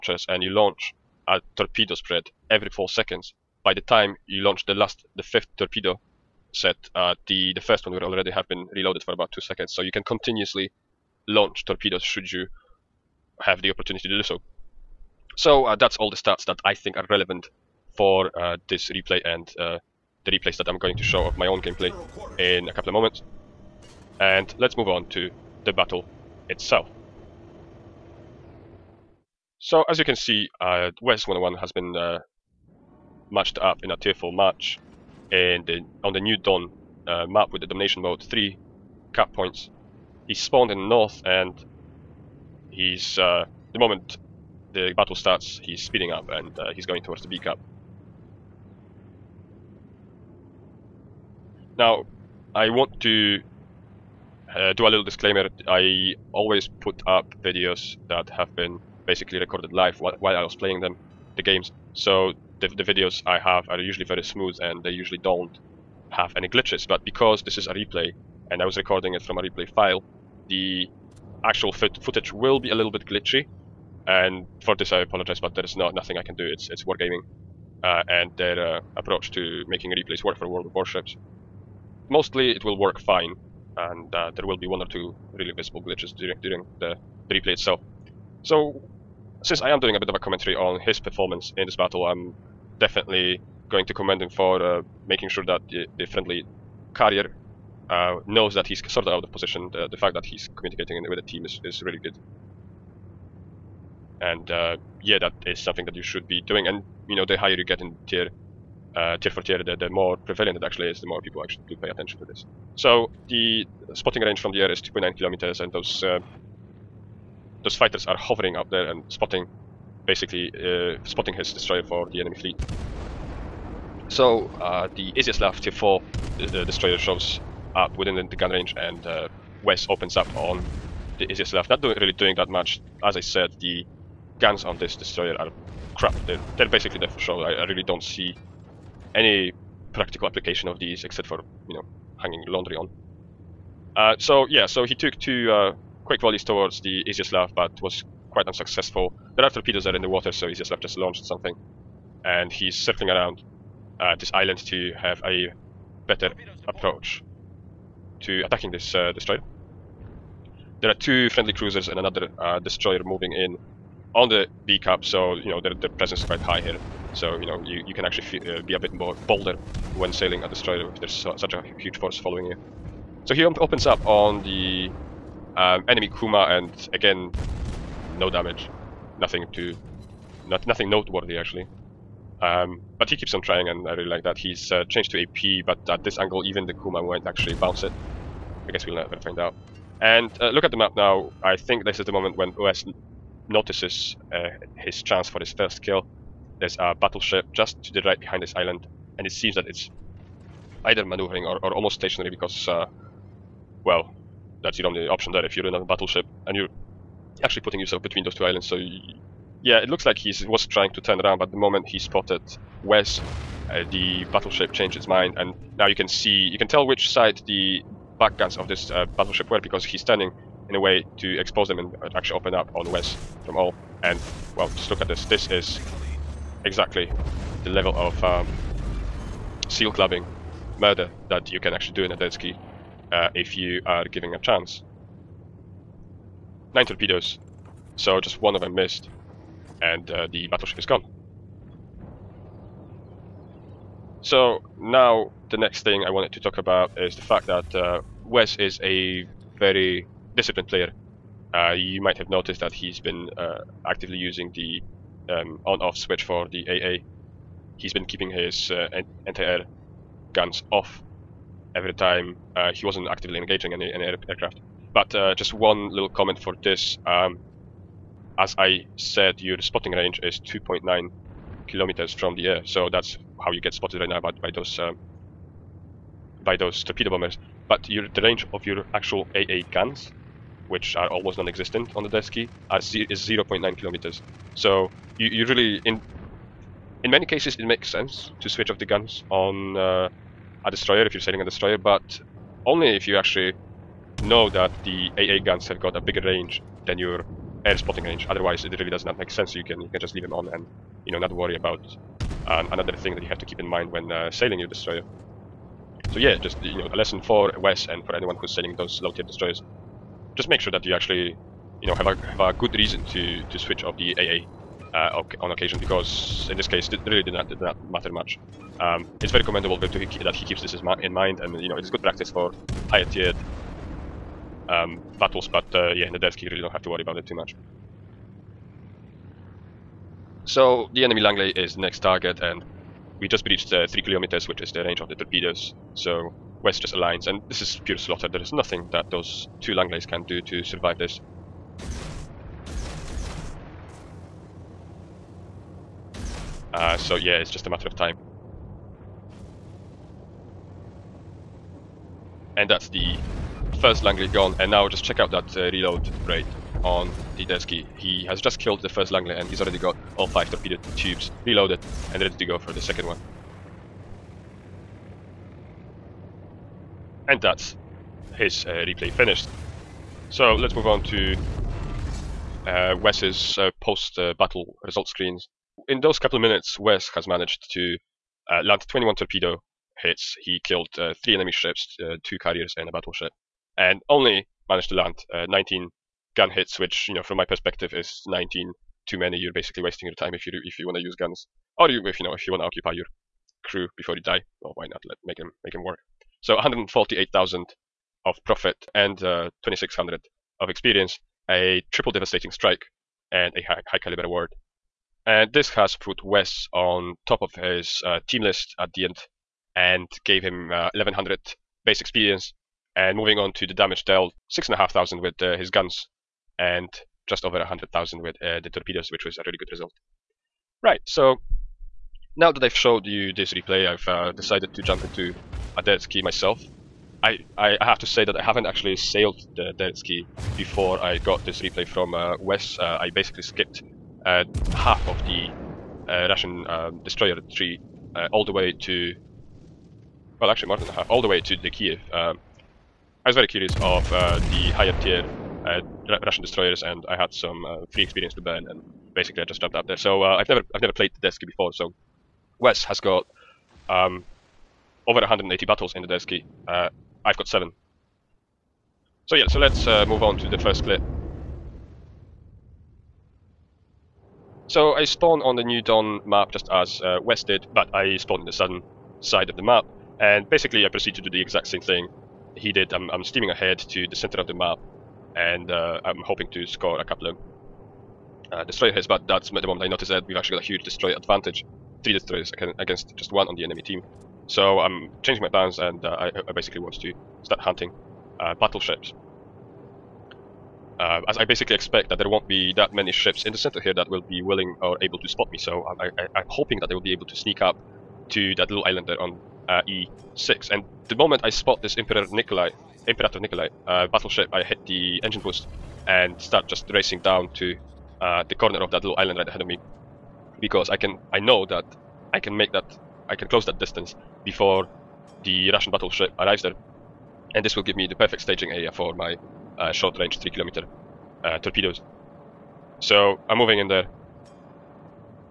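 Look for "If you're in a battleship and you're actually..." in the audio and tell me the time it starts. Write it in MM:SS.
03:25.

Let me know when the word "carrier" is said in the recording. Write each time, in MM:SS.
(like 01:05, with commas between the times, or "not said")
01:36, 06:22.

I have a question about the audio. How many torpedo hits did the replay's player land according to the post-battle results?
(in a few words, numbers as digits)
21.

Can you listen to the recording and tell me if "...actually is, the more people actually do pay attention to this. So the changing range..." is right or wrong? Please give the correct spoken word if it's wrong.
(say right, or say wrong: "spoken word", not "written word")
wrong: "spotting", not "changing".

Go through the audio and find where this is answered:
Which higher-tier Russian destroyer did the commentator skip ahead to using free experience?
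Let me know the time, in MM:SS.
07:21.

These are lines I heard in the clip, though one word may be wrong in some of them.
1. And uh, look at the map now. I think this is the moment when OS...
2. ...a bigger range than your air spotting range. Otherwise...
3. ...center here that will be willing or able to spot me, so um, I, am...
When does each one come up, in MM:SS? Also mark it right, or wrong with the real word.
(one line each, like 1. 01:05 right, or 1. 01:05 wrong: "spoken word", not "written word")
1. 03:10 right
2. 04:55 right
3. 08:13 right.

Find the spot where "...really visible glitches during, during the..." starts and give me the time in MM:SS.
01:25.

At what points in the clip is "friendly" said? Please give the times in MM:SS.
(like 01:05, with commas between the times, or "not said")
01:36, 02:41.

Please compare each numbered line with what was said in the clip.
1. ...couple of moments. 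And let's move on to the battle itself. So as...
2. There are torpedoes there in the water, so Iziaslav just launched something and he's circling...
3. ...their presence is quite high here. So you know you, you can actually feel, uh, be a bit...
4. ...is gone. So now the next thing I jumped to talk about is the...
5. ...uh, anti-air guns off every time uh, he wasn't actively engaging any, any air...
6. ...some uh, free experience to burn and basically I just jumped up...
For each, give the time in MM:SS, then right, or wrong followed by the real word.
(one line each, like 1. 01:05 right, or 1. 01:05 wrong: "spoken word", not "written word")
1. 00:22 right
2. 02:29 right
3. 02:45 right
4. 04:00 wrong: "wanted", not "jumped"
5. 04:18 right
6. 07:27 right.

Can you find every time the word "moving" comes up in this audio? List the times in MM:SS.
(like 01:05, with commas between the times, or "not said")
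02:43, 06:53, 08:43.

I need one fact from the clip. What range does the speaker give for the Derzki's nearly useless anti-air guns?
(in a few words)
0.9 kilometers.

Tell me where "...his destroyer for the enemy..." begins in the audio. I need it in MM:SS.
02:01.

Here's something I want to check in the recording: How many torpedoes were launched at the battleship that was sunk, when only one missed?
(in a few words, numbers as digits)
9.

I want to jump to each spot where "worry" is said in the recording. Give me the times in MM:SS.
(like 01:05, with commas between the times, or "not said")
05:01, 05:26.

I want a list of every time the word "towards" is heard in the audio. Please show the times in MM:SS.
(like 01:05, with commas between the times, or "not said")
00:47, 02:26.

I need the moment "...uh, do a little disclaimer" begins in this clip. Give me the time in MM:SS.
00:54.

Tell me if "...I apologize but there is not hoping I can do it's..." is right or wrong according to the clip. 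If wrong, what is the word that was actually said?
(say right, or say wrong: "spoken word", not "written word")
wrong: "nothing", not "hoping".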